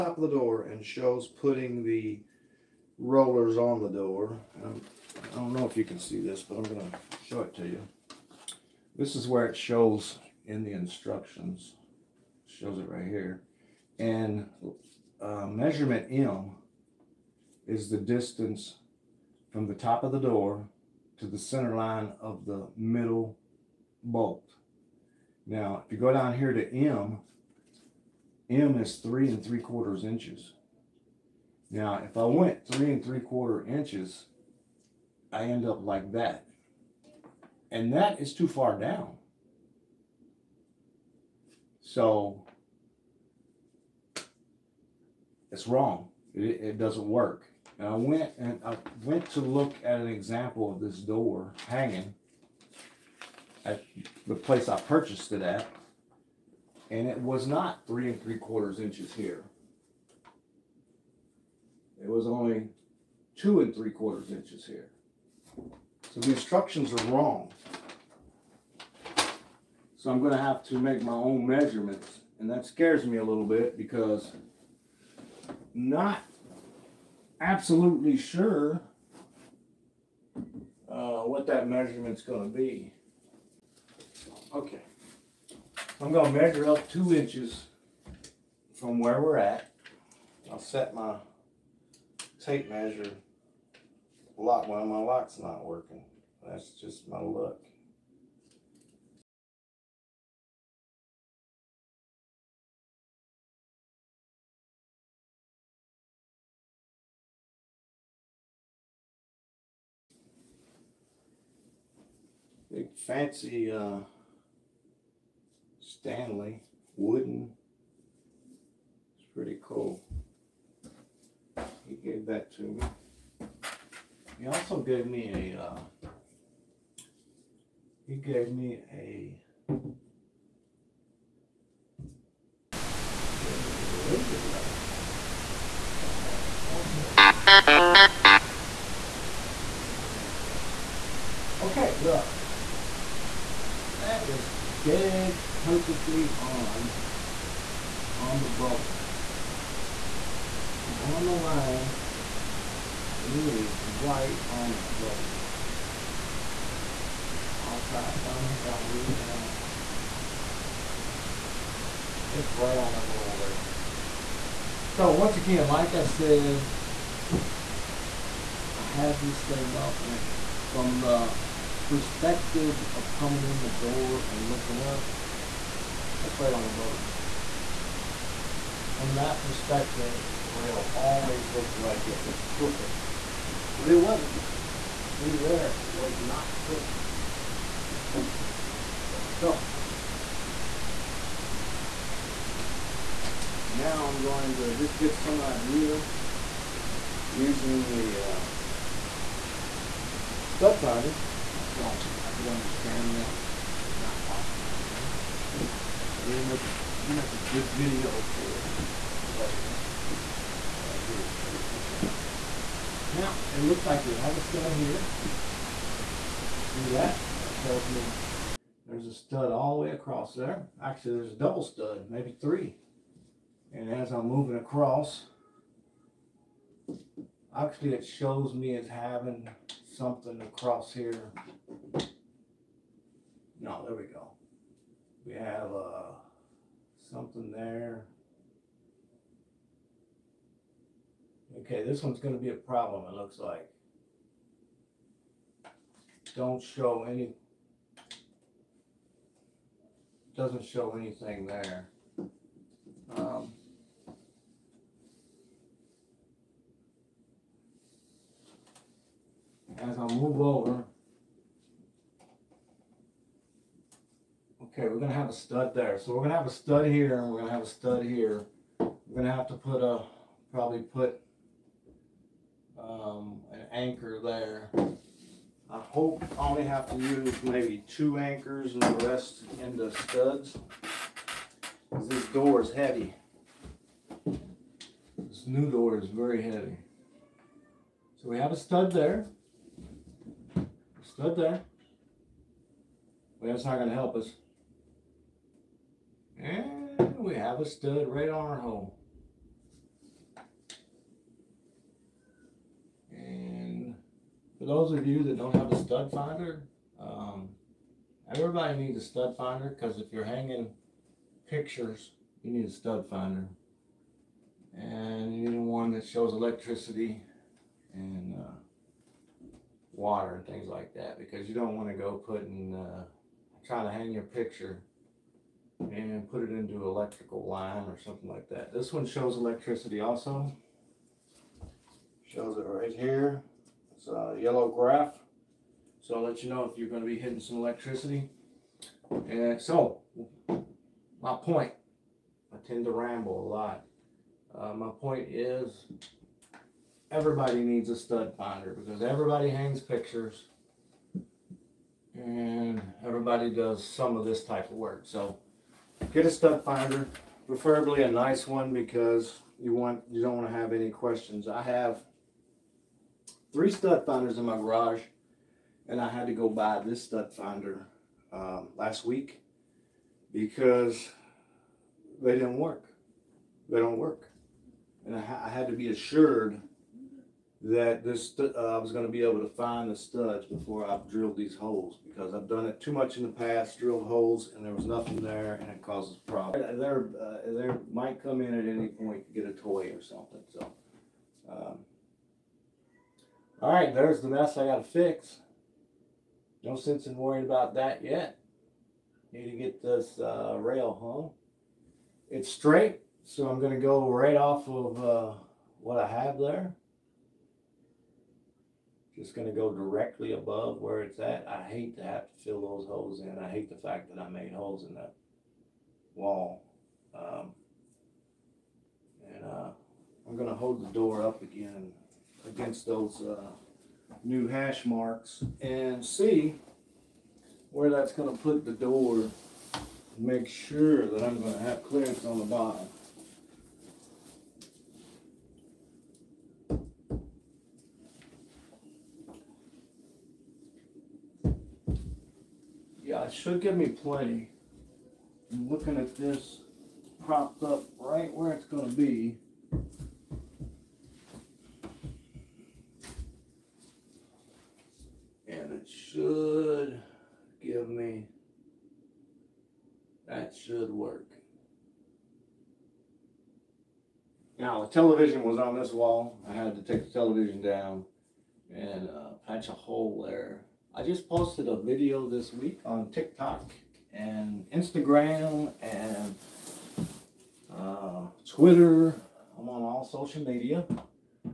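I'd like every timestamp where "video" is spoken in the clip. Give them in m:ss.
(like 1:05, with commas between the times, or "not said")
3:27, 7:51.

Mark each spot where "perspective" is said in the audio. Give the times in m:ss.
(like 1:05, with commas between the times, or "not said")
2:51, 2:59.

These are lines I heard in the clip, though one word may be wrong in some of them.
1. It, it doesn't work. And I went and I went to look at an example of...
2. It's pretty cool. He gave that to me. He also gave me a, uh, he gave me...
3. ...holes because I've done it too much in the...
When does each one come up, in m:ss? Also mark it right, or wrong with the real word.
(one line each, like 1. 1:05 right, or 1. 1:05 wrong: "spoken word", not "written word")
1. 0:46 right
2. 1:59 right
3. 6:21 right.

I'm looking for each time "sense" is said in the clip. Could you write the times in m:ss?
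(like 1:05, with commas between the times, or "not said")
6:36.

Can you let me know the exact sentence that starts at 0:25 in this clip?
Now, if you go down here to M, M is three and three quarters inches.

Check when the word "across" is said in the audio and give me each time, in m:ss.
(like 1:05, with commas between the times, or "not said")
3:39, 3:44, 3:50.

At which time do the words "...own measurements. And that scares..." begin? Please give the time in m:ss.
1:11.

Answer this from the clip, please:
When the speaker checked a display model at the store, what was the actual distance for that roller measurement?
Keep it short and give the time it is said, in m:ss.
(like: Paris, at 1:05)
2 3/4 inches, at 1:03.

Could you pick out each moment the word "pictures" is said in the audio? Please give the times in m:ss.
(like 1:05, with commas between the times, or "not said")
5:11, 5:24, 5:49.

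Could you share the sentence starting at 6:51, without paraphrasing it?
I hate to have to fill those holes in.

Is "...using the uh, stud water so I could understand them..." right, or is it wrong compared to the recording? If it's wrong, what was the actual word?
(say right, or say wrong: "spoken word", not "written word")
wrong: "finder", not "water".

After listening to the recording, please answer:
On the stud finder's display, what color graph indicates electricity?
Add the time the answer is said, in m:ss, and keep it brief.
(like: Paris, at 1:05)
yellow, at 5:34.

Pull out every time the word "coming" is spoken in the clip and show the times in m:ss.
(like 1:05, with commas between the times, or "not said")
2:53.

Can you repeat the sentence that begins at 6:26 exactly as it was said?
There, uh, there might come in at any point to get a toy or something.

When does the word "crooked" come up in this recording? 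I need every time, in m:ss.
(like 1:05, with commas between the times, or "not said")
3:02, 3:06.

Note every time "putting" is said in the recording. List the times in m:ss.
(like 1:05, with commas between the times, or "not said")
0:01, 5:22.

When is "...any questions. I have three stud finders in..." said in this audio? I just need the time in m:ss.
6:00.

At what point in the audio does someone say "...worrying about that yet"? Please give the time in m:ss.
6:37.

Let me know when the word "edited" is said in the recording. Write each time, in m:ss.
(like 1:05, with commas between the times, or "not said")
3:31.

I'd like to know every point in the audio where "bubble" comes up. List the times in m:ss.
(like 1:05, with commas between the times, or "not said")
2:28, 2:34, 2:43, 2:56.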